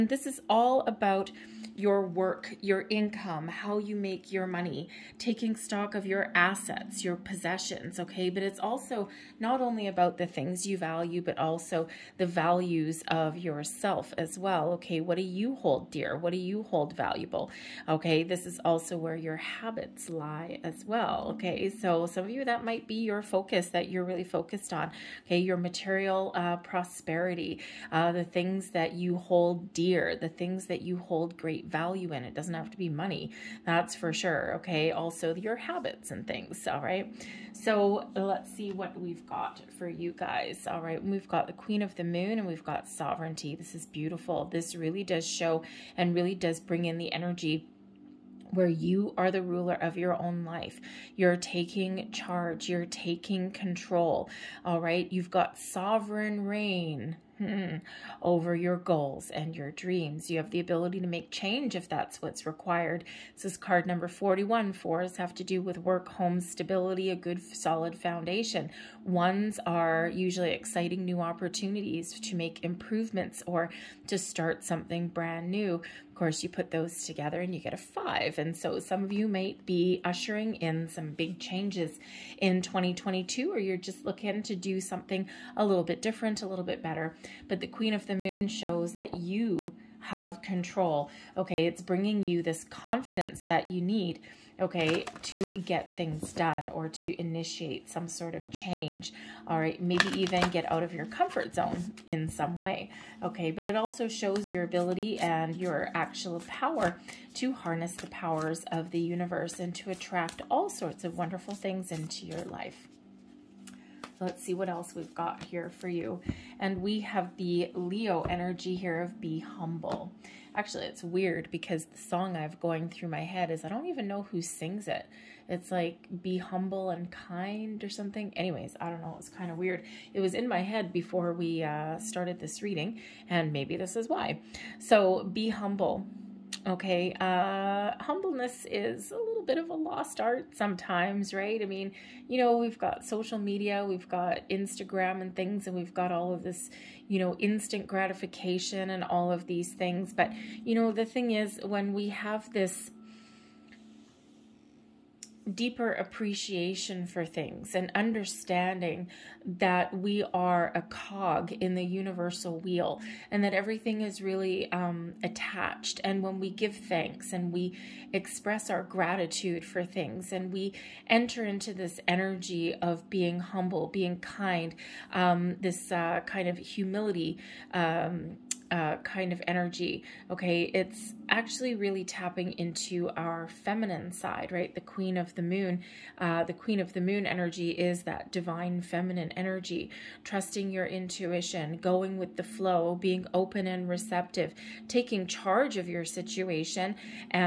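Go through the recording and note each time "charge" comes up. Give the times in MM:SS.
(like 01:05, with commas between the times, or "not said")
00:52, 03:15.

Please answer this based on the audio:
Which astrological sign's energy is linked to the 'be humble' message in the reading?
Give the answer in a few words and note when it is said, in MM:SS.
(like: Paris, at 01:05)
Leo, at 01:57.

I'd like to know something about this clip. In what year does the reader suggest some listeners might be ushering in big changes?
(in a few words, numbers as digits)
2022.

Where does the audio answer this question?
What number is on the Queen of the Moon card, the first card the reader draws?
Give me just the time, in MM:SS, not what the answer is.
01:03.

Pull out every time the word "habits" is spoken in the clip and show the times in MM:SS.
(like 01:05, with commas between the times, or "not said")
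00:19, 00:35.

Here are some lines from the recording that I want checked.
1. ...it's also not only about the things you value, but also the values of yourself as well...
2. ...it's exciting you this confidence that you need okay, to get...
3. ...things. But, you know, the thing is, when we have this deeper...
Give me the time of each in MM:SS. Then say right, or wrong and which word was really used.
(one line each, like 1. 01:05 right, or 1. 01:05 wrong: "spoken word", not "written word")
1. 00:08 right
2. 01:31 wrong: "bringing", not "exciting"
3. 02:29 right.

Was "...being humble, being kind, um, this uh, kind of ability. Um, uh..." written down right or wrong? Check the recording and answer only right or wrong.
wrong.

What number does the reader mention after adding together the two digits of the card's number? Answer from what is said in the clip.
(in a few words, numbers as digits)
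5.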